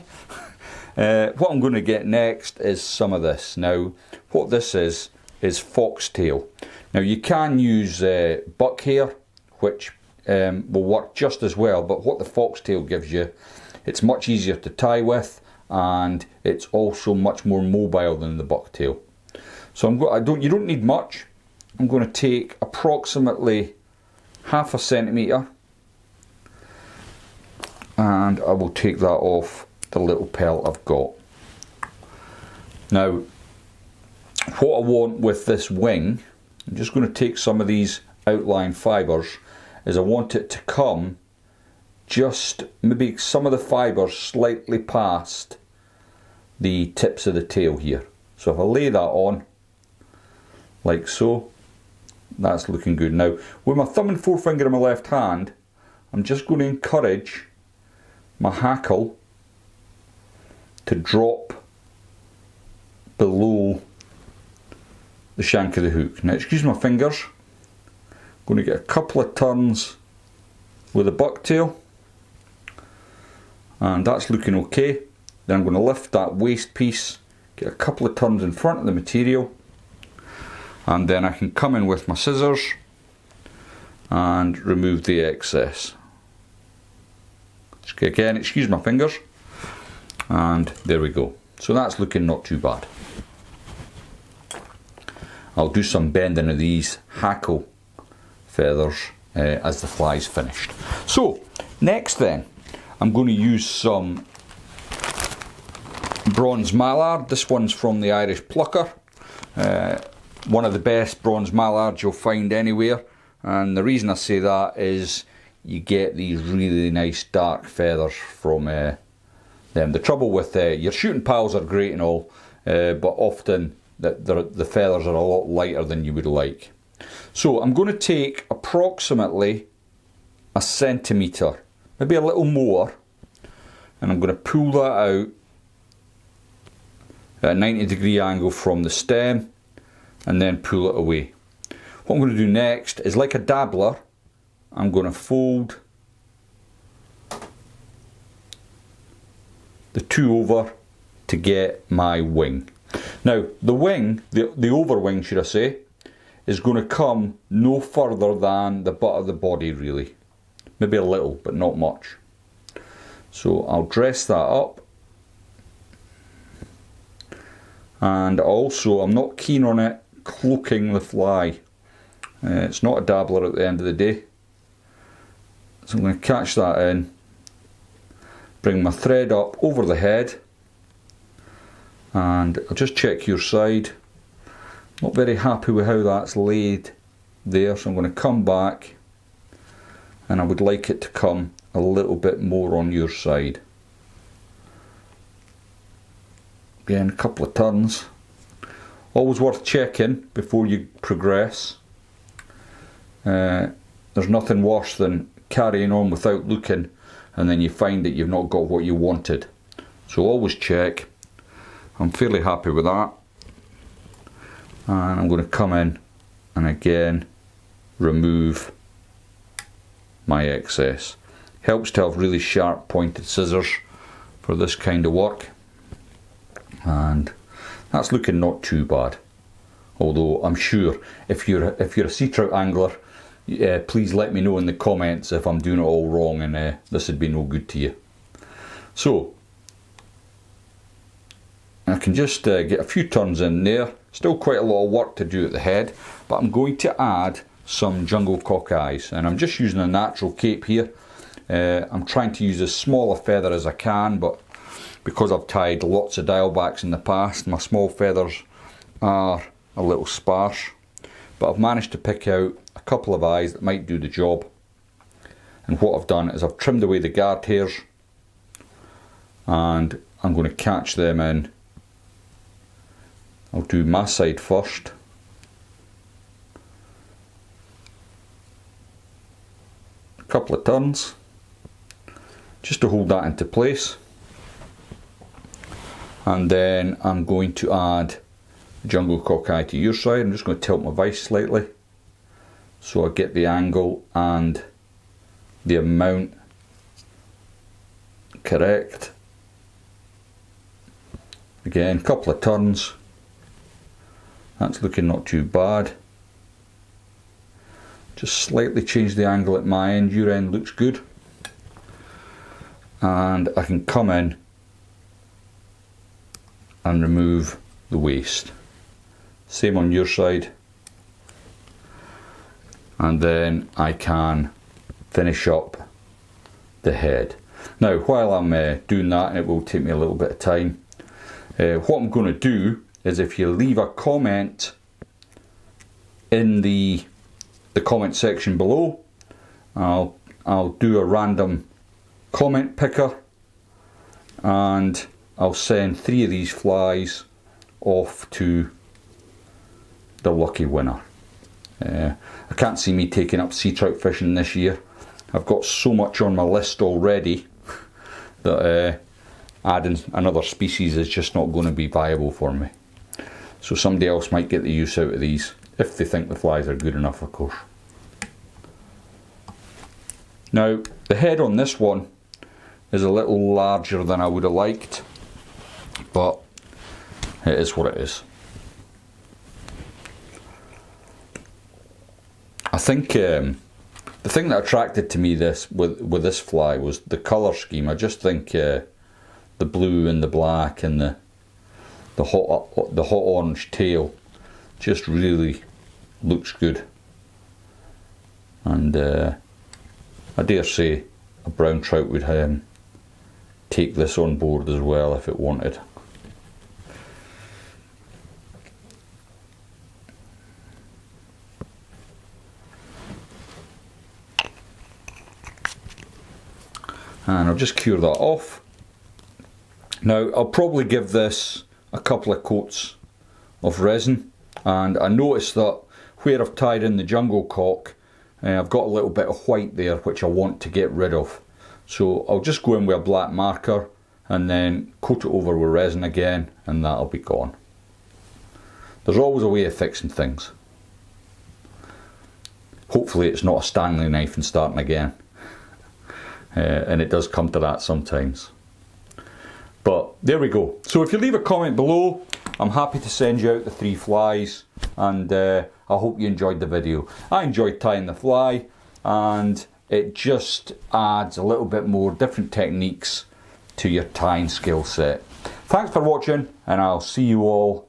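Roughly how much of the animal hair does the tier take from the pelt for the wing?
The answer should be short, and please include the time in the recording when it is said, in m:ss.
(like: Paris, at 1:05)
Half a centimetre, at 0:24.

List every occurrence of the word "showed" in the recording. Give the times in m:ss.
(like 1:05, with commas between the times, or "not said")
not said.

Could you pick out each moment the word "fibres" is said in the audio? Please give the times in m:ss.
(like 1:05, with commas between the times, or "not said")
0:38, 0:43.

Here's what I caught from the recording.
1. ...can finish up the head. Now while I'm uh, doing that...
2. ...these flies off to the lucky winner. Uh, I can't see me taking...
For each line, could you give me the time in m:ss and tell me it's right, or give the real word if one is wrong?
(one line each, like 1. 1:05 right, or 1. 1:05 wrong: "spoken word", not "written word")
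1. 5:23 right
2. 5:46 right.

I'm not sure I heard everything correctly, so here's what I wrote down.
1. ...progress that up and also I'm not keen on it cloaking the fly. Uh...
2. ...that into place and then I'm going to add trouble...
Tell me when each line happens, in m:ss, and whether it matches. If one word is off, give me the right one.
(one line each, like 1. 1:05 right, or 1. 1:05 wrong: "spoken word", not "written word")
1. 2:43 wrong: "dress", not "progress"
2. 4:43 wrong: "jungle", not "trouble".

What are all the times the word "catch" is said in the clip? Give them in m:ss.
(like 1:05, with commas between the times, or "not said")
2:56, 4:30.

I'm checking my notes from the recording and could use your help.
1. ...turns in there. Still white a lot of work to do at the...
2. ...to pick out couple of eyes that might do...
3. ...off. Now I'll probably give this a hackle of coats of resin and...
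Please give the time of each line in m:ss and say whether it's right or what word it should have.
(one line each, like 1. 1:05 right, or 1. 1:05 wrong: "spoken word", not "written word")
1. 4:03 wrong: "quite", not "white"
2. 4:21 right
3. 6:58 wrong: "couple", not "hackle".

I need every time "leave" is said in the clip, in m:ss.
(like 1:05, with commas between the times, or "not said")
5:33, 7:31.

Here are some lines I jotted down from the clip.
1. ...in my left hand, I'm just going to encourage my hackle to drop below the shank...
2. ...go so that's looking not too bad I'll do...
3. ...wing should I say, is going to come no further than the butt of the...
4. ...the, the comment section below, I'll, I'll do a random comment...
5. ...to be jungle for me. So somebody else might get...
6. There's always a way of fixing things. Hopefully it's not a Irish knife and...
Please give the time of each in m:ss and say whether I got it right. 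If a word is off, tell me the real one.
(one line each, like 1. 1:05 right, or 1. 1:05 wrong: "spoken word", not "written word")
1. 0:54 right
2. 1:31 right
3. 2:34 right
4. 5:36 right
5. 6:01 wrong: "viable", not "jungle"
6. 7:19 wrong: "Stanley", not "Irish".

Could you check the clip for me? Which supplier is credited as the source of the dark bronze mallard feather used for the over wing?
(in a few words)
The Irish plucker.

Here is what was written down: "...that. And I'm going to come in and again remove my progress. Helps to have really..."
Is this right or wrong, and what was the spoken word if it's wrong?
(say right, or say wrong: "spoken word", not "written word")
wrong: "excess", not "progress".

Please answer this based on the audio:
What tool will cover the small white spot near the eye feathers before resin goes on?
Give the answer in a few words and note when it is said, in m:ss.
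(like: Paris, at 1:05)
A black marker, at 7:13.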